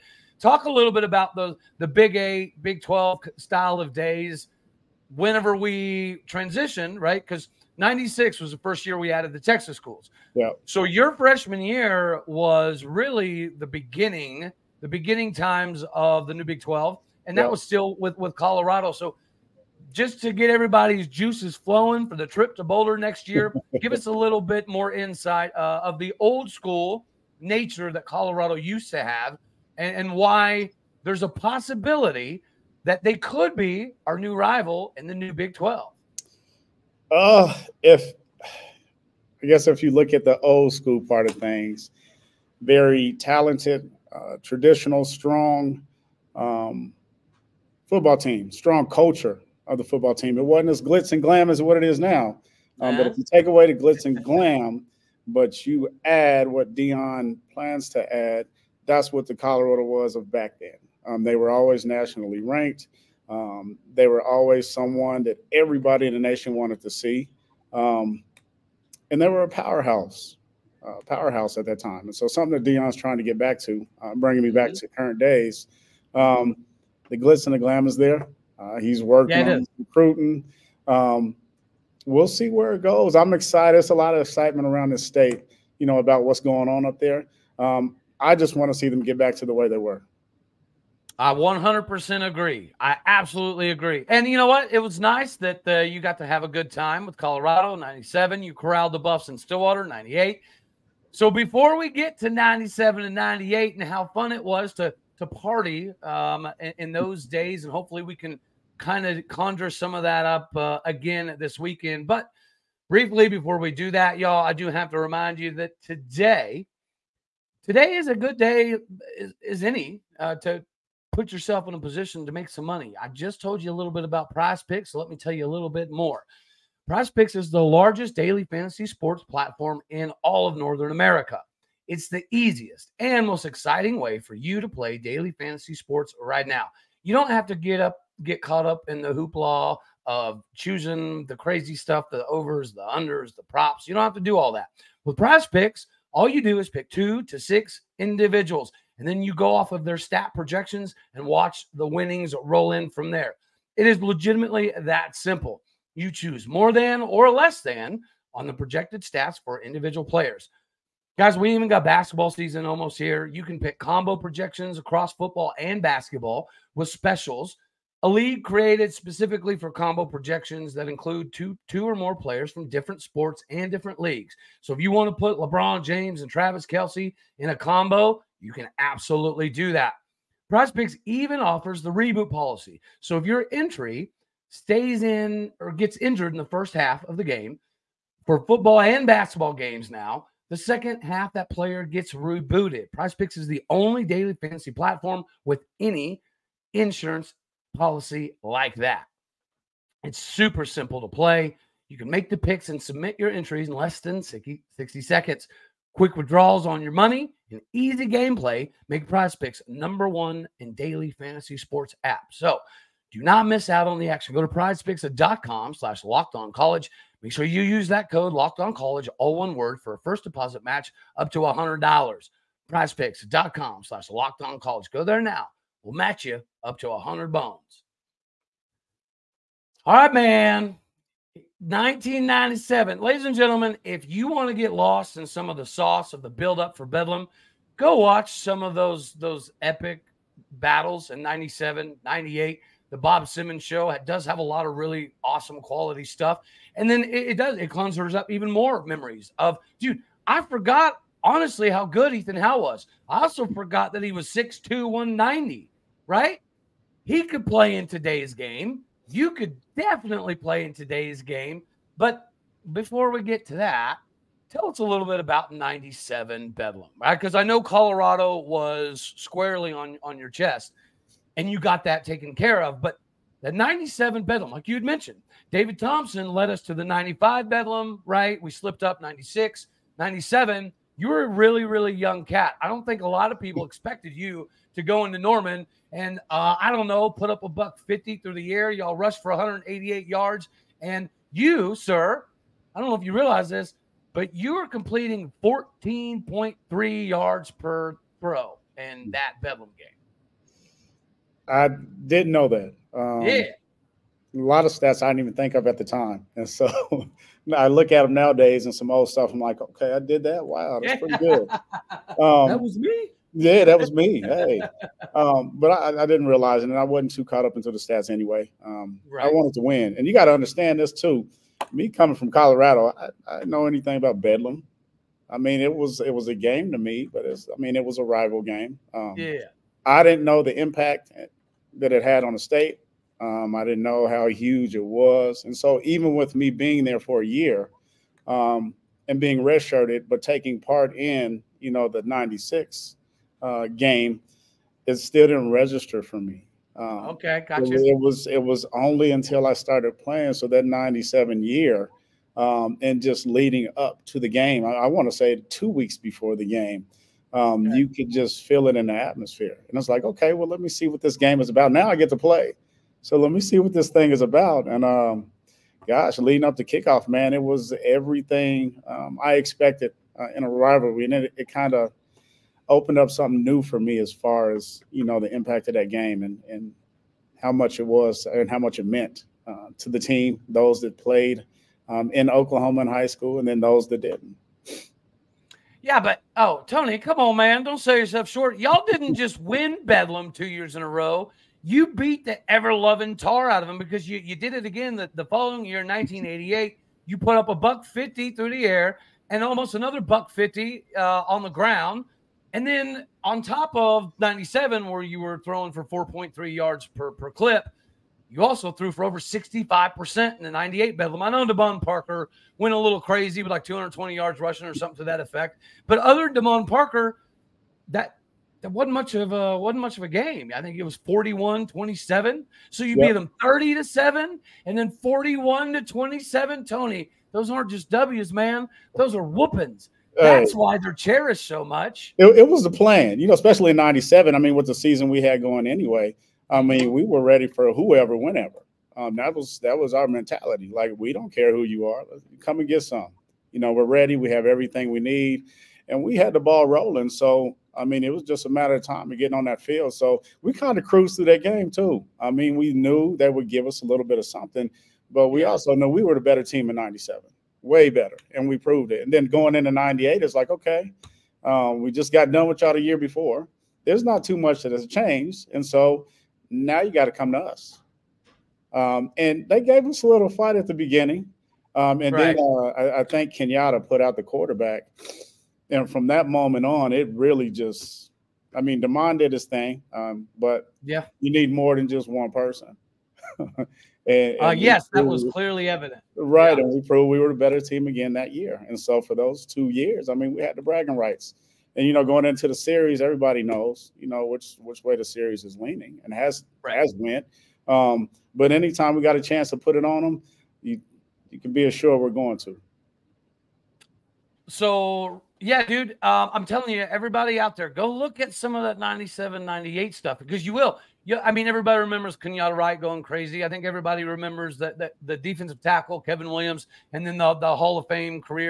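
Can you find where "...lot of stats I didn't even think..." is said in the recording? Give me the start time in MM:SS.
05:04.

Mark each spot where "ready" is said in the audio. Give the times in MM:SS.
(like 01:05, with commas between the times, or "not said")
07:17, 07:23.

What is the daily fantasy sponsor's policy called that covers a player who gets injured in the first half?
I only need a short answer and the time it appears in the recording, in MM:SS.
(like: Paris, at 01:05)
reboot policy, at 03:01.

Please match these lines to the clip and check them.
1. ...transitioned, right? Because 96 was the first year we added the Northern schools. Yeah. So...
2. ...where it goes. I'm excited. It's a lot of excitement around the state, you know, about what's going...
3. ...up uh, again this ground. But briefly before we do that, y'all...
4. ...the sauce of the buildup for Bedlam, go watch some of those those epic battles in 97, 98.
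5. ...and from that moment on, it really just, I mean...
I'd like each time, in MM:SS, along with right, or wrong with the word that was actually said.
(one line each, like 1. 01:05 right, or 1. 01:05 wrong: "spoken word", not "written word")
1. 00:06 wrong: "Texas", not "Northern"
2. 01:22 right
3. 01:50 wrong: "weekend", not "ground"
4. 03:55 right
5. 07:55 right.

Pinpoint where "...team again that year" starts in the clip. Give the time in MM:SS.
08:07.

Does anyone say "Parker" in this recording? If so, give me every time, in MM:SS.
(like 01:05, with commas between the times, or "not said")
06:51, 06:56.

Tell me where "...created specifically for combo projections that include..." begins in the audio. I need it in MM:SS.
02:48.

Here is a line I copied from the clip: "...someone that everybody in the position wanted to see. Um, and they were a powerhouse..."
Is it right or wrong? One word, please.
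wrong.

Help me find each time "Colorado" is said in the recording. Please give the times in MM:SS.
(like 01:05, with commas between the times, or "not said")
00:18, 00:28, 00:59, 01:37, 04:27, 05:22.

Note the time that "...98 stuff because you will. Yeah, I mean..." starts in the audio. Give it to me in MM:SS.
08:29.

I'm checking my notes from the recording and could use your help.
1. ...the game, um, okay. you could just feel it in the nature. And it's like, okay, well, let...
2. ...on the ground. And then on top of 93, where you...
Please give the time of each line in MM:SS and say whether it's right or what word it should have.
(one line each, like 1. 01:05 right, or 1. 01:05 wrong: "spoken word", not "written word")
1. 05:56 wrong: "atmosphere", not "nature"
2. 06:41 wrong: "97", not "93".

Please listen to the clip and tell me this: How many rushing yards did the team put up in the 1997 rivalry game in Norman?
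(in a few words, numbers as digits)
188.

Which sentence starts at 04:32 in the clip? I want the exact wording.
But the 97 Bedlam, like you had mentioned, David Thompson led us to the 95 Bedlam, right?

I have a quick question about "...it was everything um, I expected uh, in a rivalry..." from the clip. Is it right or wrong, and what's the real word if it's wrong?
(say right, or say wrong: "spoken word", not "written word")
right.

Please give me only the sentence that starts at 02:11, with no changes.
It's the easiest and most exciting way for you to play daily fantasy sports right now.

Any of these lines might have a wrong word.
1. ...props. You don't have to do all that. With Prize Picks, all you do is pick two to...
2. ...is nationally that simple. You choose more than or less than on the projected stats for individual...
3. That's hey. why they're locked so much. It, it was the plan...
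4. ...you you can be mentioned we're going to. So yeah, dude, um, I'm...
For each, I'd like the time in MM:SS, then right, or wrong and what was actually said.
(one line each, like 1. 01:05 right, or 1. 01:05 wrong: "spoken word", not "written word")
1. 02:23 right
2. 02:33 wrong: "legitimately", not "nationally"
3. 07:10 wrong: "cherished", not "locked"
4. 08:20 wrong: "assured", not "mentioned".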